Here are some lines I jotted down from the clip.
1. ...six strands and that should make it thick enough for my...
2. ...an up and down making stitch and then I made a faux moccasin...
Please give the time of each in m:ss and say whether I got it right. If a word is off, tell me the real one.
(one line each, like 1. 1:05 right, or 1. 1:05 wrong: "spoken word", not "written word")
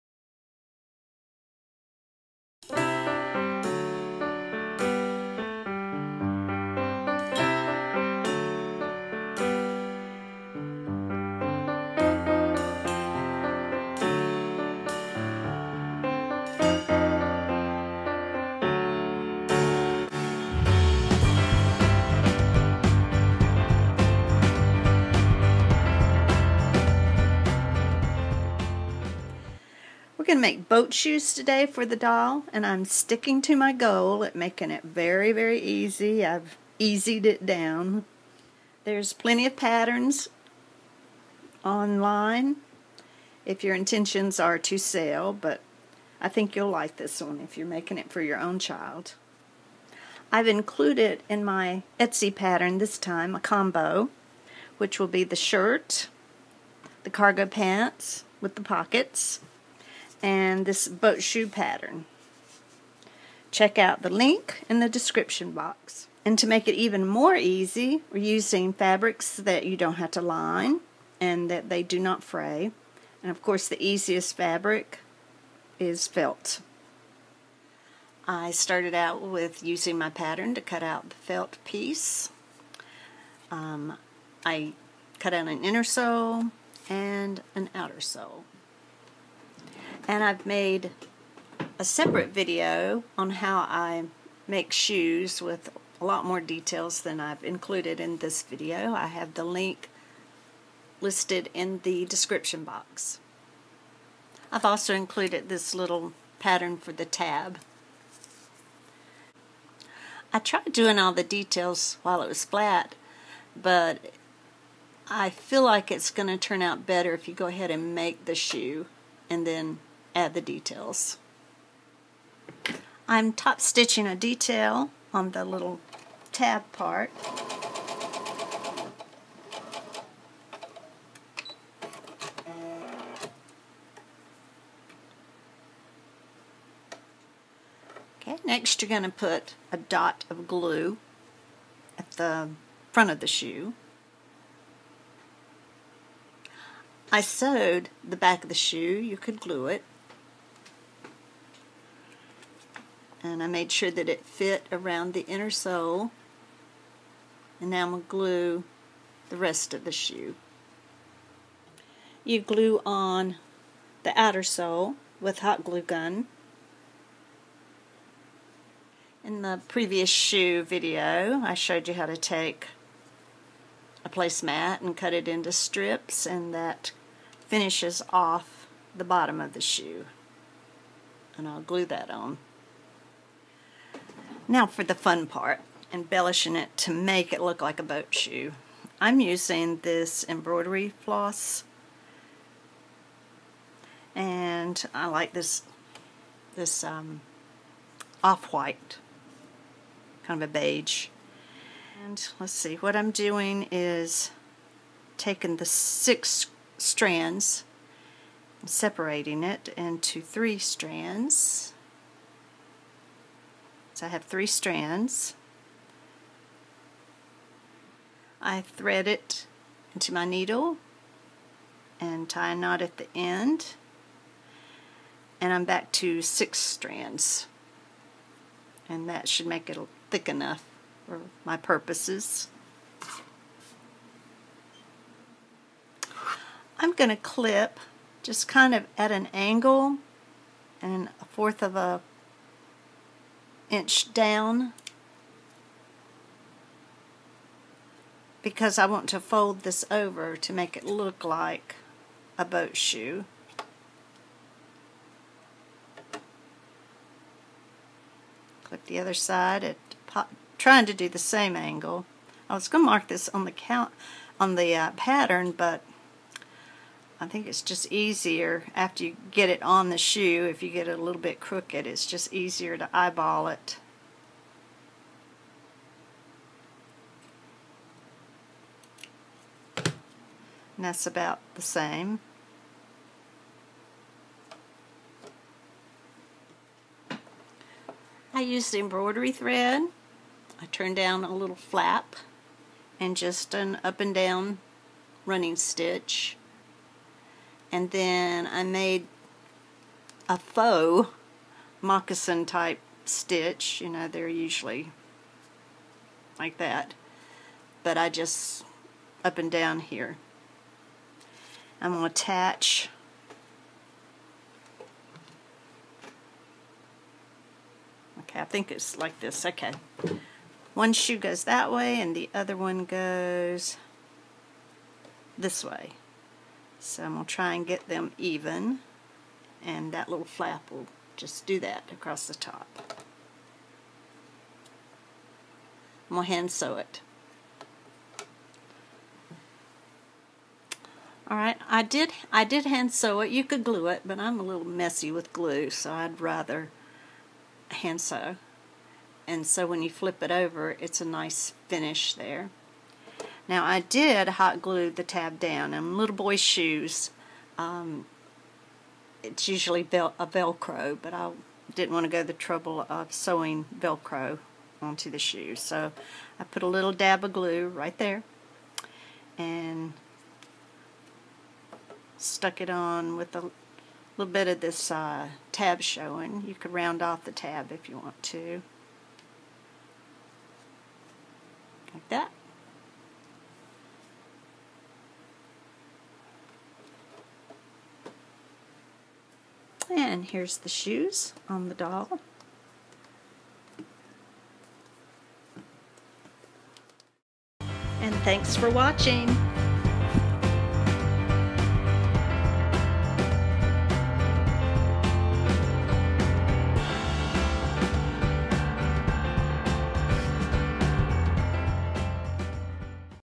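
1. 3:46 right
2. 4:53 wrong: "running", not "making".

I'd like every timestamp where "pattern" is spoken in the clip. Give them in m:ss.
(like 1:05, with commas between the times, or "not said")
0:39, 0:52, 1:01, 1:20, 1:46, 4:24.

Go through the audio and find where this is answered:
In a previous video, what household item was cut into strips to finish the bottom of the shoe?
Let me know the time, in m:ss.
2:54.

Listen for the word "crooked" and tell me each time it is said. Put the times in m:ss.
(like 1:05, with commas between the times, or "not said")
4:31.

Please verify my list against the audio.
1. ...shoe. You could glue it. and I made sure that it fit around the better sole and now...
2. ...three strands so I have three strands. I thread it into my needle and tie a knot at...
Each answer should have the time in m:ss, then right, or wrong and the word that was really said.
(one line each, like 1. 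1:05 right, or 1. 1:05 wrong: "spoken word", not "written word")
1. 2:28 wrong: "inner", not "better"
2. 3:30 right.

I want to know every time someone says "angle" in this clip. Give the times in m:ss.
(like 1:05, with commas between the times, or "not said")
3:59, 4:21.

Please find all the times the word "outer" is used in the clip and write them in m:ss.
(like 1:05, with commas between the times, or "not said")
1:27, 2:44.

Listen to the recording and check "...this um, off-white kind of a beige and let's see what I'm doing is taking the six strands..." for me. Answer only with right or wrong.
right.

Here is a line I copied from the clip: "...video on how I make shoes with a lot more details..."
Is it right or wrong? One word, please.
right.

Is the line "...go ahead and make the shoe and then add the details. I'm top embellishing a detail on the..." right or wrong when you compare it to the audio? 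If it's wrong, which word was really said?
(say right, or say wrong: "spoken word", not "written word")
wrong: "stitching", not "embellishing".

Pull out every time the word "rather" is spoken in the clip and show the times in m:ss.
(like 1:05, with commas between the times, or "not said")
5:46.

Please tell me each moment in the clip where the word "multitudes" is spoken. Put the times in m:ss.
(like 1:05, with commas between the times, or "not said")
not said.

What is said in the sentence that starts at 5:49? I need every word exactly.
And so when you flip it over, it's a nice finish there.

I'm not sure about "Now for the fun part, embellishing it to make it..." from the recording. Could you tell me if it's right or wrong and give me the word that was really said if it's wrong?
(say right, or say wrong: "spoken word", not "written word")
right.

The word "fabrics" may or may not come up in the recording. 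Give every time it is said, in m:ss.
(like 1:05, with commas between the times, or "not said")
1:08, 1:14.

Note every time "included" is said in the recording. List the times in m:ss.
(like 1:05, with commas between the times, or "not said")
0:50, 1:37, 1:44.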